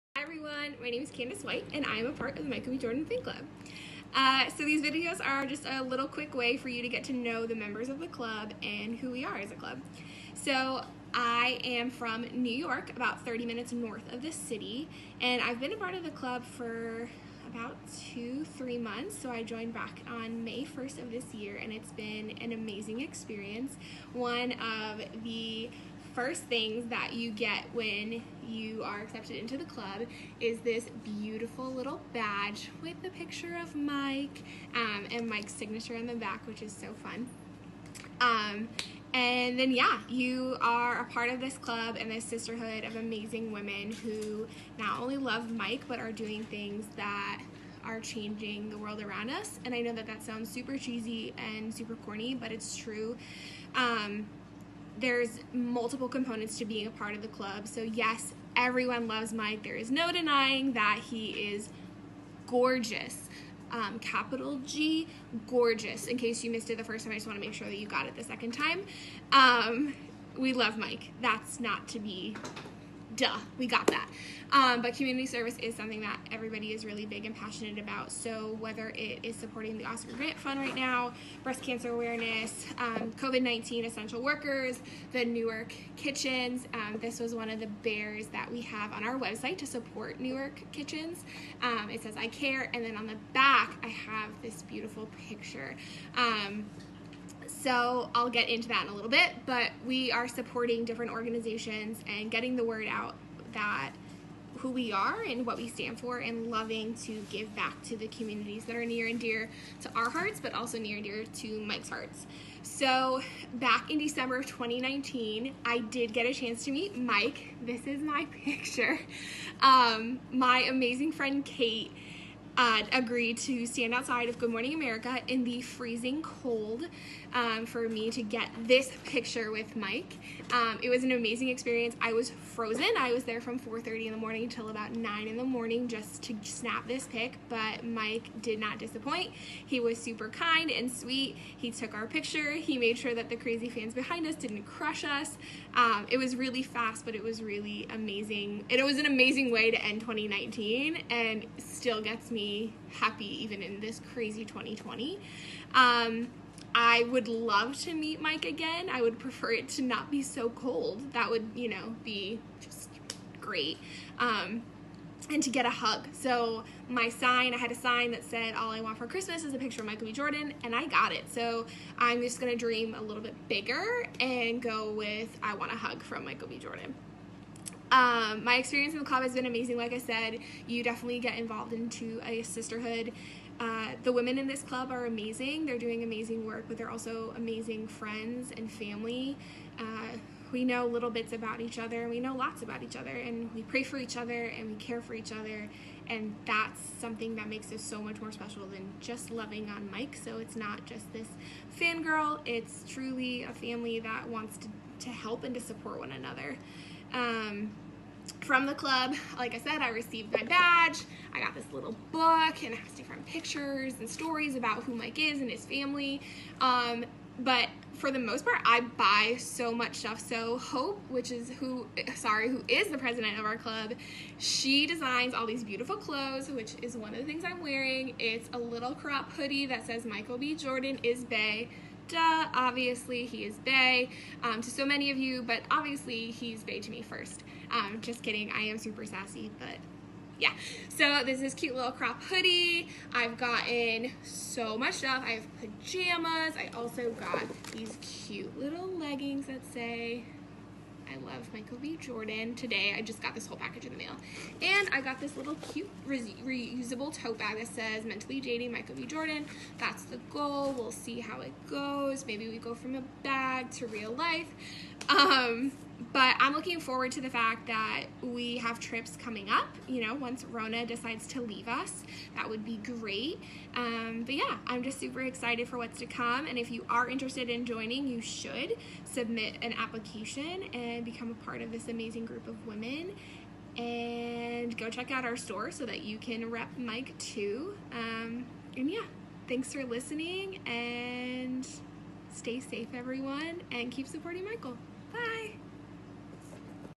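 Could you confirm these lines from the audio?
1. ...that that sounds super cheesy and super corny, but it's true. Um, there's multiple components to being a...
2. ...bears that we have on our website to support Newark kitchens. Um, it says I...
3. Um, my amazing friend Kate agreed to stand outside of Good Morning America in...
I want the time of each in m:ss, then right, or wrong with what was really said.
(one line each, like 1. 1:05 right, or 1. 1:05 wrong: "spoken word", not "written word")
1. 0:49 right
2. 1:27 right
3. 1:59 right.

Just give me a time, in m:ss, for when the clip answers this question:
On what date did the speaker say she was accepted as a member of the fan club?
0:20.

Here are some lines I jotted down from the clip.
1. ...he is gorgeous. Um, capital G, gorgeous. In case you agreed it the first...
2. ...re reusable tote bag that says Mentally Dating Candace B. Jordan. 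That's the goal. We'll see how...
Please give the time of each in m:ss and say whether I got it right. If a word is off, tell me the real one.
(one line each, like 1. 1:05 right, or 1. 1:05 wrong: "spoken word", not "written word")
1. 1:01 wrong: "missed", not "agreed"
2. 4:16 wrong: "Michael", not "Candace".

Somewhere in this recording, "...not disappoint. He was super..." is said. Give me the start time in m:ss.
2:18.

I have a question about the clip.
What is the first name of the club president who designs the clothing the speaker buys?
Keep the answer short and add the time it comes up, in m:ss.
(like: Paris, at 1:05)
Hope, at 3:40.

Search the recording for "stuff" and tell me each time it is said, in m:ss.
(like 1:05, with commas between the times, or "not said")
3:39, 4:04.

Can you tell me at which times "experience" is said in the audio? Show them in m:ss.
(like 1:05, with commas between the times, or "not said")
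0:23, 2:11, 2:58.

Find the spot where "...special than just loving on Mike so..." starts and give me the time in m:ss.
3:18.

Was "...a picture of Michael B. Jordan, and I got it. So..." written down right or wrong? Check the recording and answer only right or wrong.
right.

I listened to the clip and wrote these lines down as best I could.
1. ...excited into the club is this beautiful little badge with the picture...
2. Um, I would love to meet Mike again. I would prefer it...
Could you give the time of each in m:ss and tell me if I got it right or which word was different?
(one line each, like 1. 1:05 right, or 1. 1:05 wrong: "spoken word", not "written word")
1. 0:29 wrong: "accepted", not "excited"
2. 2:35 right.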